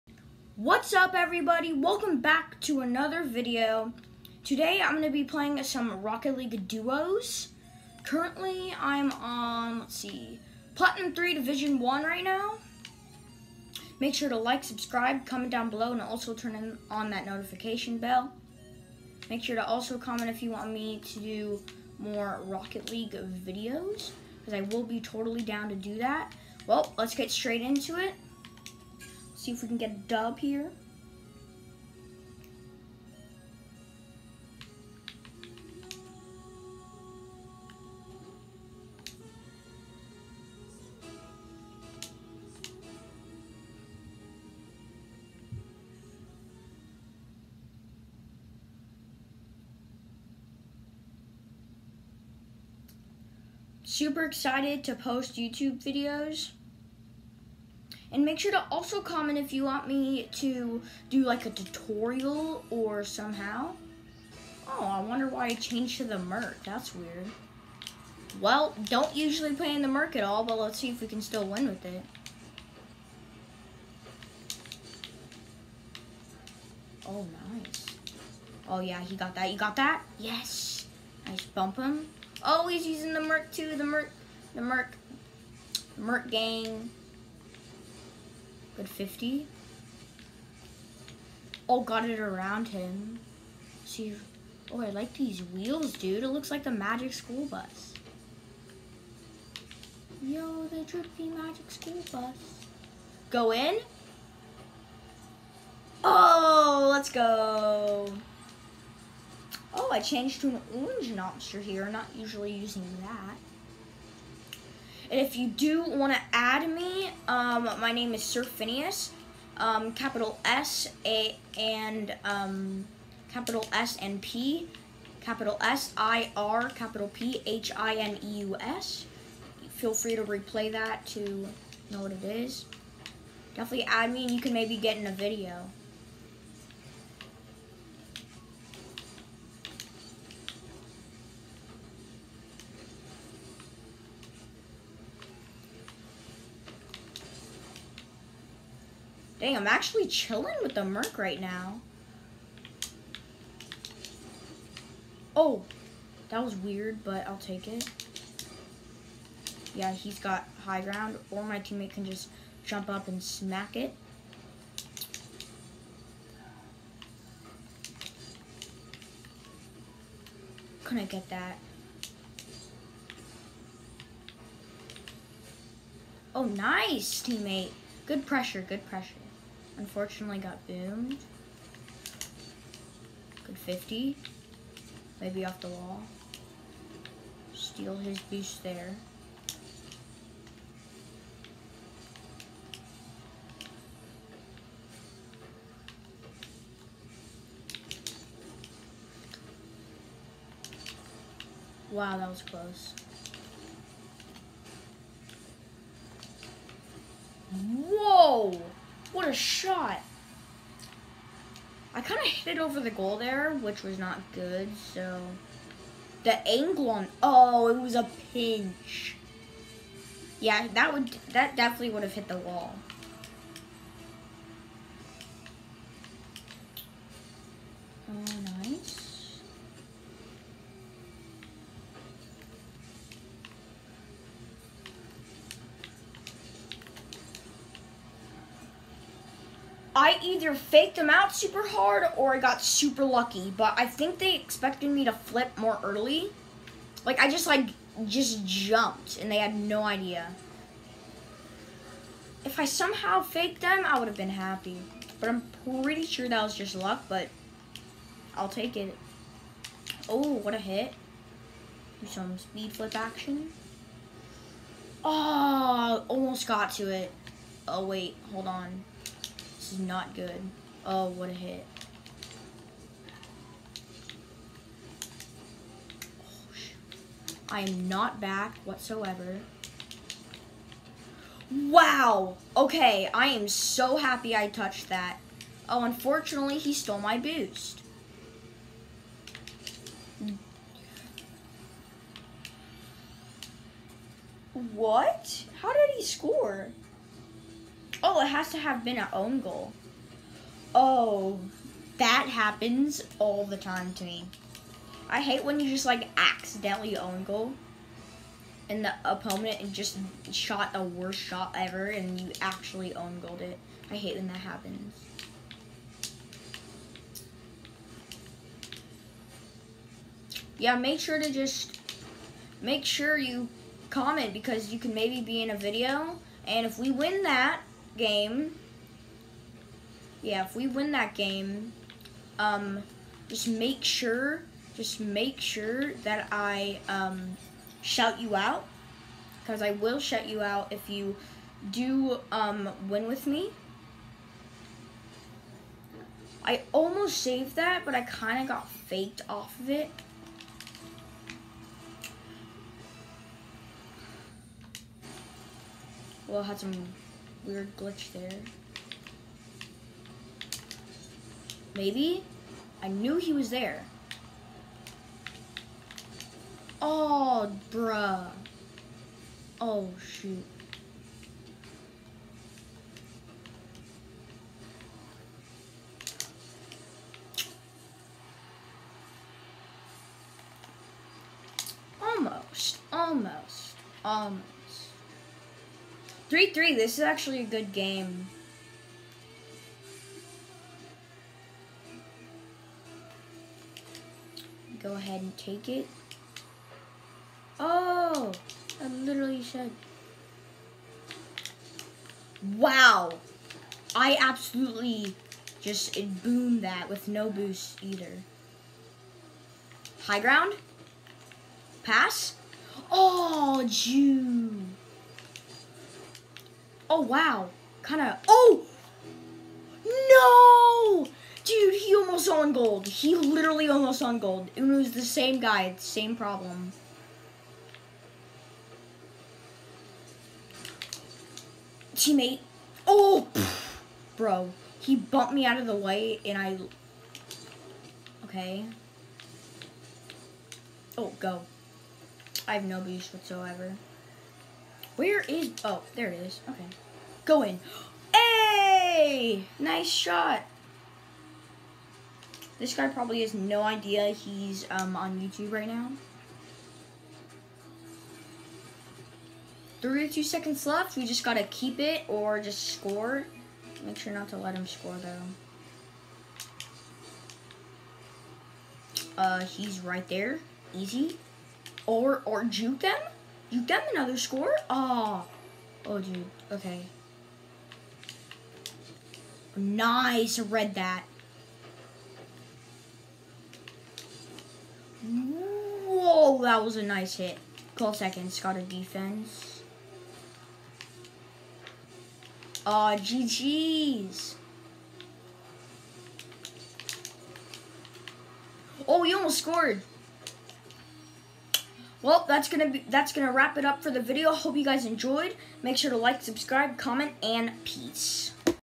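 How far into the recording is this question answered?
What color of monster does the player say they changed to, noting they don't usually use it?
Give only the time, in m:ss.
1:50.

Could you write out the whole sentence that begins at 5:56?
Well, I some weird glitch there.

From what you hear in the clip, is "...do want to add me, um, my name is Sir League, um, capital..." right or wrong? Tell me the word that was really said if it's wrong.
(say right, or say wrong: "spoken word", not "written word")
wrong: "Phineus", not "League".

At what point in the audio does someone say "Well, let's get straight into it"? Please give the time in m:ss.
0:26.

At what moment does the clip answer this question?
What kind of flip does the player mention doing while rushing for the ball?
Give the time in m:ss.
4:22.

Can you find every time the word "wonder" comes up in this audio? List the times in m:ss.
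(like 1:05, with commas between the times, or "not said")
1:05.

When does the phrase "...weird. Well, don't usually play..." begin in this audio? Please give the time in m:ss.
1:06.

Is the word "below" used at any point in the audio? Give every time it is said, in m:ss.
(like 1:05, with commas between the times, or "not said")
0:15.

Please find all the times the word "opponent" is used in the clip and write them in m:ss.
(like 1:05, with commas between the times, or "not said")
5:09.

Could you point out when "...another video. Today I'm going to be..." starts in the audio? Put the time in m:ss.
0:02.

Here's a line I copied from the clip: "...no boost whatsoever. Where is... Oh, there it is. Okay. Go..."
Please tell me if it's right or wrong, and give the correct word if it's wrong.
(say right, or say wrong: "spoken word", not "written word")
right.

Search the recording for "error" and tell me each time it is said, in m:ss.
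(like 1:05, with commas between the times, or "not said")
not said.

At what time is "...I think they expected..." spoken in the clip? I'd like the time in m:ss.
4:03.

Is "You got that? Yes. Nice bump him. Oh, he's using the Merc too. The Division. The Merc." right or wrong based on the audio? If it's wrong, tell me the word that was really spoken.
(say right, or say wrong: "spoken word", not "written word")
wrong: "Merc", not "Division".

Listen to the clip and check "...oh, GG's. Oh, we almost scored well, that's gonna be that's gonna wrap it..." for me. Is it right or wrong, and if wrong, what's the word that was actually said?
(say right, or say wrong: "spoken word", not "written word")
right.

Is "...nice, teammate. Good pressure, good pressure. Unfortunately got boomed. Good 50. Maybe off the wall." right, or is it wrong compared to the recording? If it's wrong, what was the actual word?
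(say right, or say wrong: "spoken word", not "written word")
right.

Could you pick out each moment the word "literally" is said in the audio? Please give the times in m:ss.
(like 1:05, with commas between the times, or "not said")
6:38, 7:03.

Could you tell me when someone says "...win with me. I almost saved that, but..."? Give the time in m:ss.
5:42.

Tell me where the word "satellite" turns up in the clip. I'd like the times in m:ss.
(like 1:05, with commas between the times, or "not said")
not said.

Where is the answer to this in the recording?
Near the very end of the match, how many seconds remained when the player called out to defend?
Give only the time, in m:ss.
8:07.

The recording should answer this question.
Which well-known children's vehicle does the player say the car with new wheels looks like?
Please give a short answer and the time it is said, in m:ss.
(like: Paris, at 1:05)
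the magic school bus, at 1:36.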